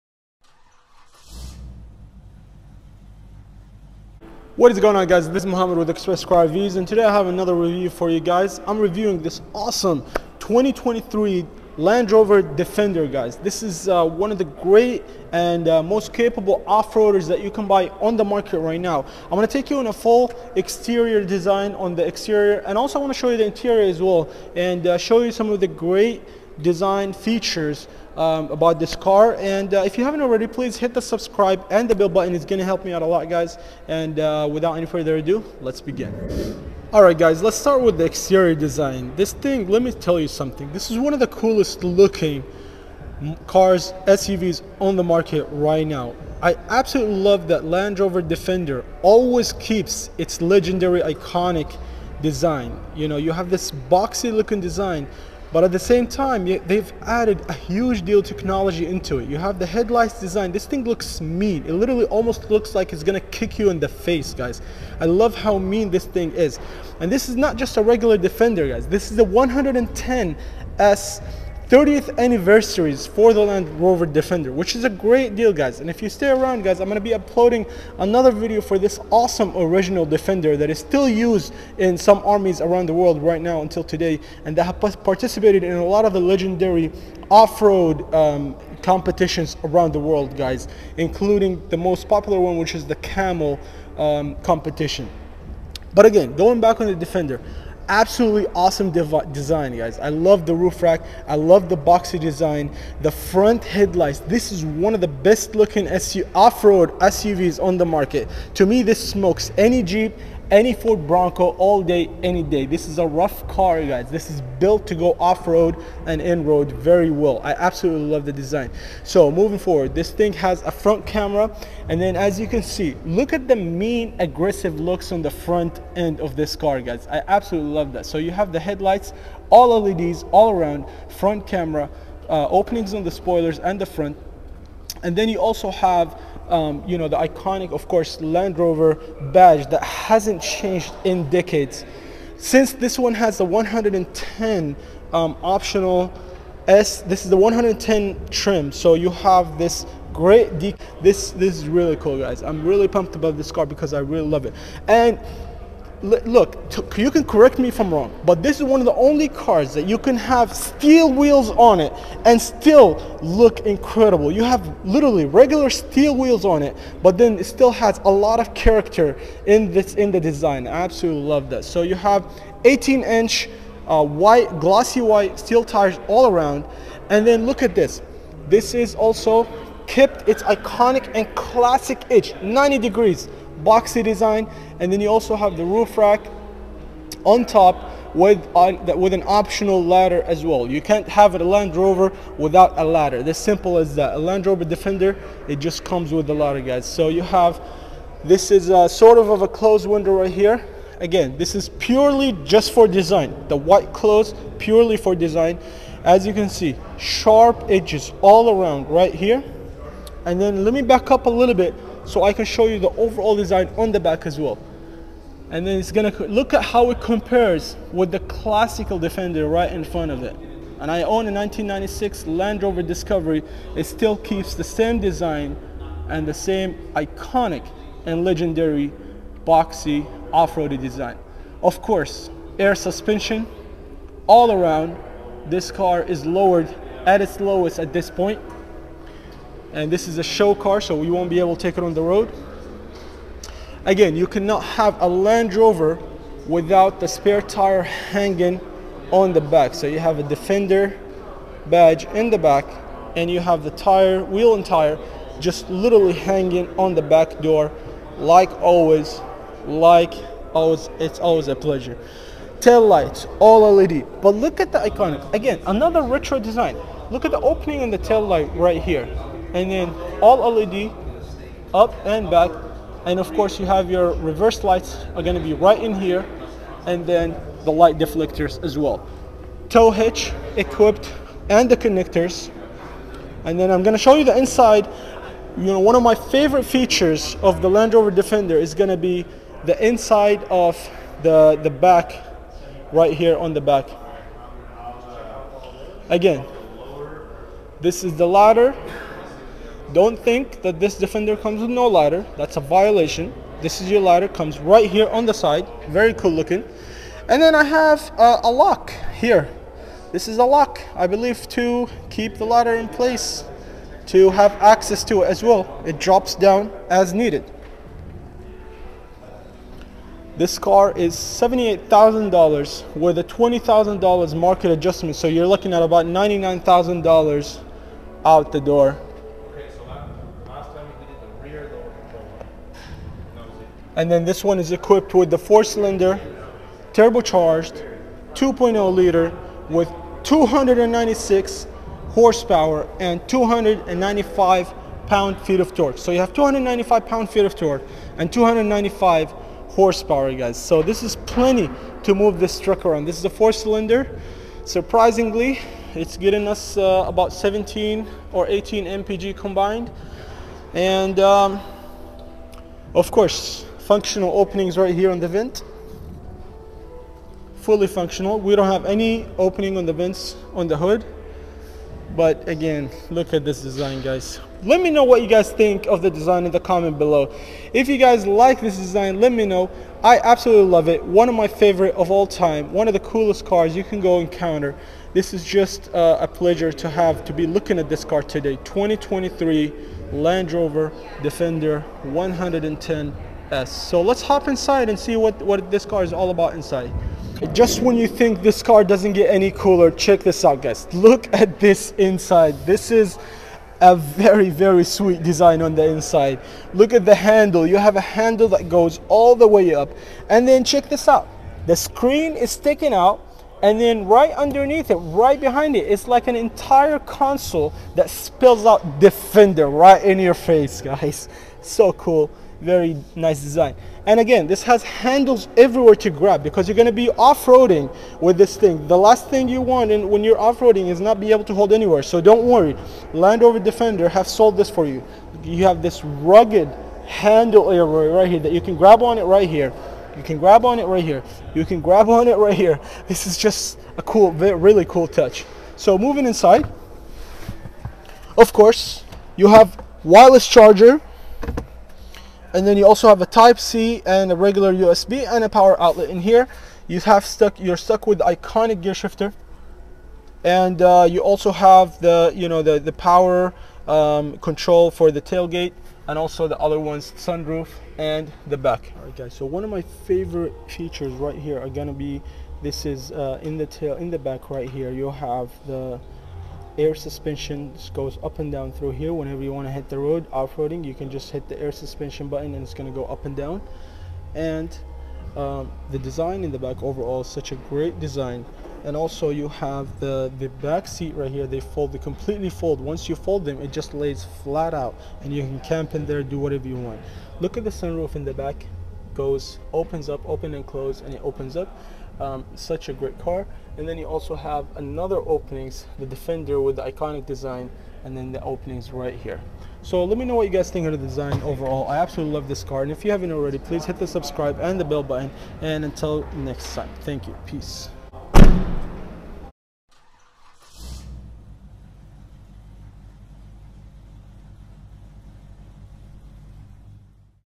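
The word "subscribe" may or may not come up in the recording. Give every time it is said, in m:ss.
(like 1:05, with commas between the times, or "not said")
0:31, 8:34.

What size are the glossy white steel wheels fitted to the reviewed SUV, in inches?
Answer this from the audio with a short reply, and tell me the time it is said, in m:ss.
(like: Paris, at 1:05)
18, at 2:52.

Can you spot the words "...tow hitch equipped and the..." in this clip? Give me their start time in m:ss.
4:39.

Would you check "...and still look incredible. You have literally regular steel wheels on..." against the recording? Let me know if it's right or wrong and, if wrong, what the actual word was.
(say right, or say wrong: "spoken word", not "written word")
right.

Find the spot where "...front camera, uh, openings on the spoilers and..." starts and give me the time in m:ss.
2:11.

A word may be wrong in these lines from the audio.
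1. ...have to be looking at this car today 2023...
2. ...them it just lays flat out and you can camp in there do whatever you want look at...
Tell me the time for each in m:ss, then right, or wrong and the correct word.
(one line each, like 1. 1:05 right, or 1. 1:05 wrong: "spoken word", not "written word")
1. 6:26 right
2. 8:13 right.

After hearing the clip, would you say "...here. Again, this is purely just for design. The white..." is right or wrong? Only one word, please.
right.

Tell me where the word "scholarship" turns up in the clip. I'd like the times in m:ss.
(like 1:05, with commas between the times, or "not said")
not said.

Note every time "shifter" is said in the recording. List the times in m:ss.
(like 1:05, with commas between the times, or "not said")
7:38.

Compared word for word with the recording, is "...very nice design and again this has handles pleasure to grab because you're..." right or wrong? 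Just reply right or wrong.
wrong.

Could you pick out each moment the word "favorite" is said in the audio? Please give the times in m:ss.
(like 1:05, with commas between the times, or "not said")
4:46, 6:21, 7:50.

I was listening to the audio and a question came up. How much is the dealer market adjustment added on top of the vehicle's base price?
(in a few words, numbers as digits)
$20,000.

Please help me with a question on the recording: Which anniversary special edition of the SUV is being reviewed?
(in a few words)
30th anniversary.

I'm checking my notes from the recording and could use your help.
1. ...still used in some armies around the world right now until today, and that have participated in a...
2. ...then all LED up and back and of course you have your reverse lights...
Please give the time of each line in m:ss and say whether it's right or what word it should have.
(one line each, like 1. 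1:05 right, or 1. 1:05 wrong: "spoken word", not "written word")
1. 1:20 right
2. 4:29 right.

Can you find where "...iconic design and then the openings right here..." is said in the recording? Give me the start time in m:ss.
8:26.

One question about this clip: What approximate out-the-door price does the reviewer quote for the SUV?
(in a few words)
$99,000.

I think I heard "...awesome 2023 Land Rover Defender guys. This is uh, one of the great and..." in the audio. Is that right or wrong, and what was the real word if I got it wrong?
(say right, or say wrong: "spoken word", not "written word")
right.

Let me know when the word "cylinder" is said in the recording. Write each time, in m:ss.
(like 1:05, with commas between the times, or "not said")
5:35, 5:53.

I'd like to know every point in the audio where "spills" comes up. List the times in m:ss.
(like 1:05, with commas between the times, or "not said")
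6:58.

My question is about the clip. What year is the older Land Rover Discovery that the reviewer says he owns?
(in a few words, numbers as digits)
1996.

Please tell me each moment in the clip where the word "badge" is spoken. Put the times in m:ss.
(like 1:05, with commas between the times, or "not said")
2:19, 4:11.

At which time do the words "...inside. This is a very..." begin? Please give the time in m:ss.
6:41.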